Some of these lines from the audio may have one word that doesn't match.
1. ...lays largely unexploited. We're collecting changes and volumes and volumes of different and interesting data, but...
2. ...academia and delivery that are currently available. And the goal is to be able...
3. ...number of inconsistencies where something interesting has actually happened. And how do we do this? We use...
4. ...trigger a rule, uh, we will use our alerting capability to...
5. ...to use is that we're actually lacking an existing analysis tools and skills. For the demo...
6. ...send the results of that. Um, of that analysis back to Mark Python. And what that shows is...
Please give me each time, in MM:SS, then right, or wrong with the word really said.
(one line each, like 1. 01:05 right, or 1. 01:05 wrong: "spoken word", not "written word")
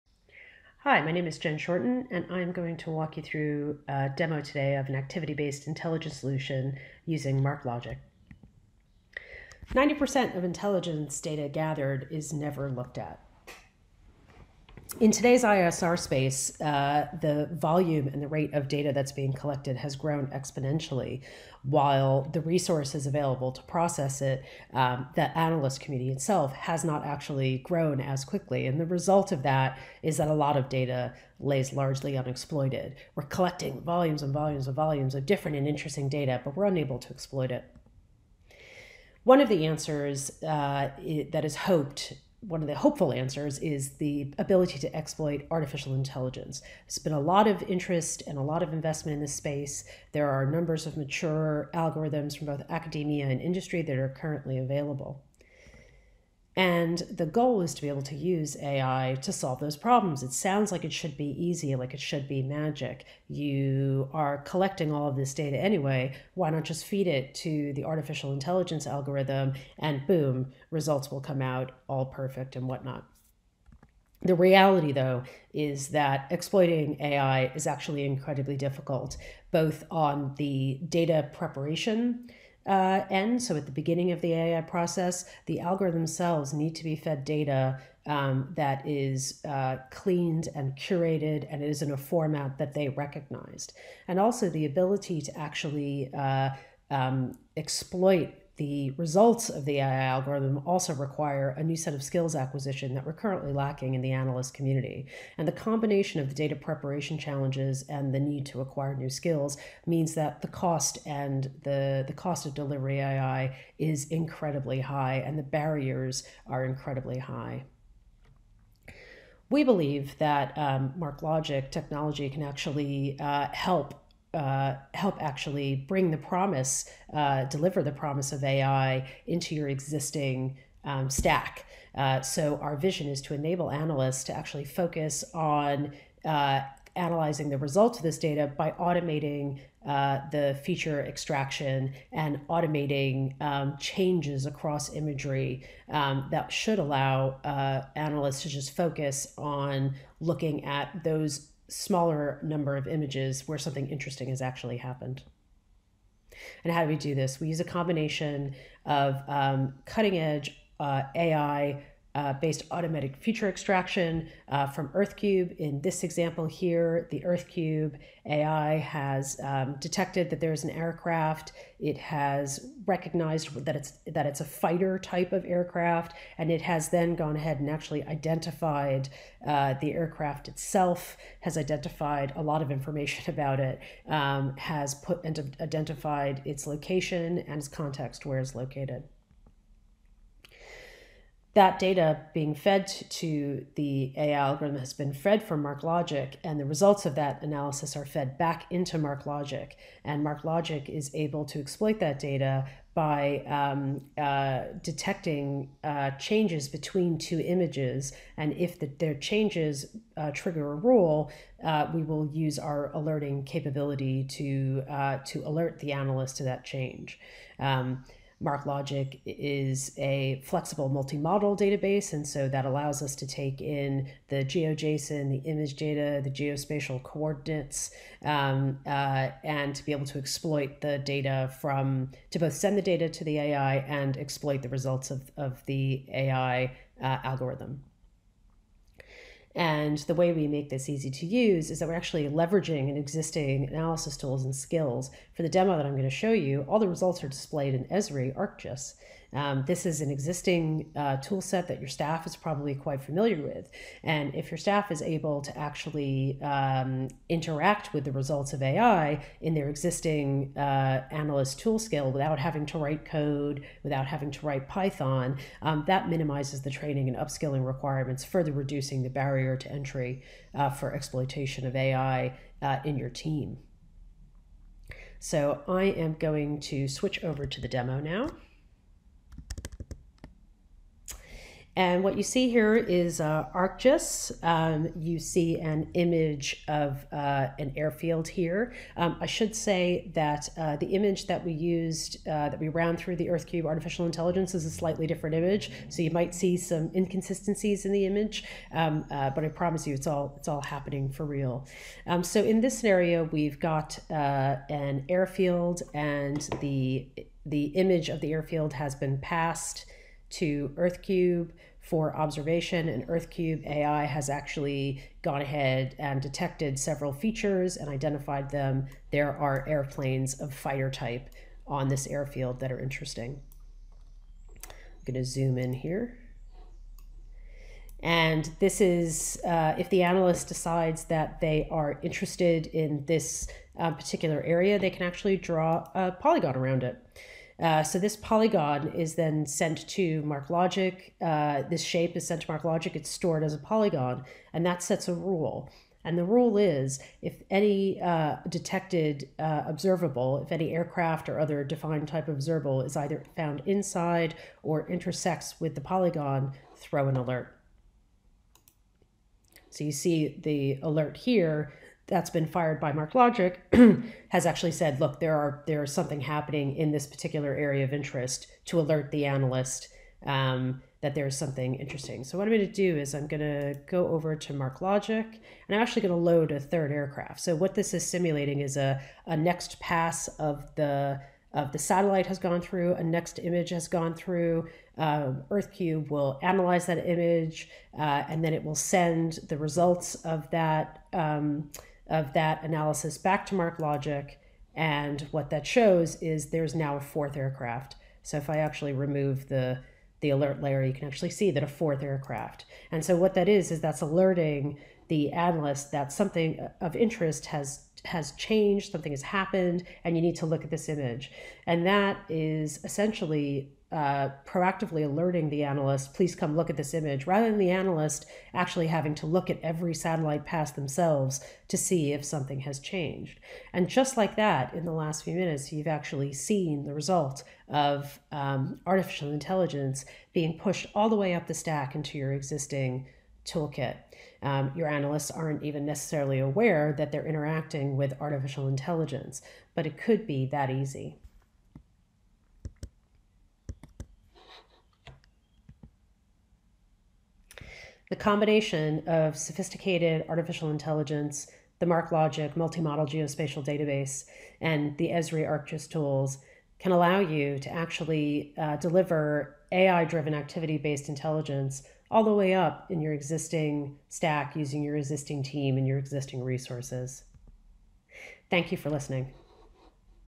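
1. 00:31 wrong: "volumes", not "changes"
2. 00:52 wrong: "industry", not "delivery"
3. 02:32 wrong: "images", not "inconsistencies"
4. 03:30 right
5. 04:01 wrong: "leveraging", not "lacking"
6. 06:28 wrong: "Logic", not "Python".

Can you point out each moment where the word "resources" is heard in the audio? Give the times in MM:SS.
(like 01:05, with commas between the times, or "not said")
00:22, 07:46.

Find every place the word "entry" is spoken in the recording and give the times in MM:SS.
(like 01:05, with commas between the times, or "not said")
04:29.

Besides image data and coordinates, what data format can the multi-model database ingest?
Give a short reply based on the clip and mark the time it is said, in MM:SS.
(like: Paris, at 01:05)
GeoJSON, at 03:44.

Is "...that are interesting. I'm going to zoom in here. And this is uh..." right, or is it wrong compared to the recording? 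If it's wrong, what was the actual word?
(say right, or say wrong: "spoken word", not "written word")
right.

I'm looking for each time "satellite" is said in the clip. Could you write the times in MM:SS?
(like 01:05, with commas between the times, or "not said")
06:21, 06:59.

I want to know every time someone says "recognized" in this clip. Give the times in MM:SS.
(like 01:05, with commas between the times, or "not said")
01:32, 02:52.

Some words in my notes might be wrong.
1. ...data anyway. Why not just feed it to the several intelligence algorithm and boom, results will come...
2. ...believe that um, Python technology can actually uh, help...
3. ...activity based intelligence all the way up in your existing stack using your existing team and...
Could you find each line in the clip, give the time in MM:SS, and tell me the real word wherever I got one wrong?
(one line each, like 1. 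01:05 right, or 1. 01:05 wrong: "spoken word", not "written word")
1. 01:05 wrong: "artificial", not "several"
2. 01:59 wrong: "MarkLogic", not "Python"
3. 07:40 right.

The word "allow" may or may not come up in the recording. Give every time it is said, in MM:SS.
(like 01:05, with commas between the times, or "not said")
02:26, 03:42, 07:36.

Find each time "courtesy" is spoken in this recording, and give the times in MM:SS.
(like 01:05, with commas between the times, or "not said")
not said.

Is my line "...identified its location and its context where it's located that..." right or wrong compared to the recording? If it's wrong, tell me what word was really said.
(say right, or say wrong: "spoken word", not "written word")
right.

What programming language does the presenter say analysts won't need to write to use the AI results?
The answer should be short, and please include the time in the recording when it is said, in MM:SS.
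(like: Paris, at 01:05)
Python, at 04:24.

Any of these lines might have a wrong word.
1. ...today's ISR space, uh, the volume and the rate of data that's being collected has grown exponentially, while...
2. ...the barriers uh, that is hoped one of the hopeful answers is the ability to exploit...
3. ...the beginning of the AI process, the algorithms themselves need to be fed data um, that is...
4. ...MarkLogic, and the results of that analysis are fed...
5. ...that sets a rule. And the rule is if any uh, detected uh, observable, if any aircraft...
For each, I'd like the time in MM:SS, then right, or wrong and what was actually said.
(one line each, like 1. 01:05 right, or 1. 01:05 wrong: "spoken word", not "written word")
1. 00:15 right
2. 00:39 wrong: "answers", not "barriers"
3. 01:23 right
4. 03:15 right
5. 05:44 right.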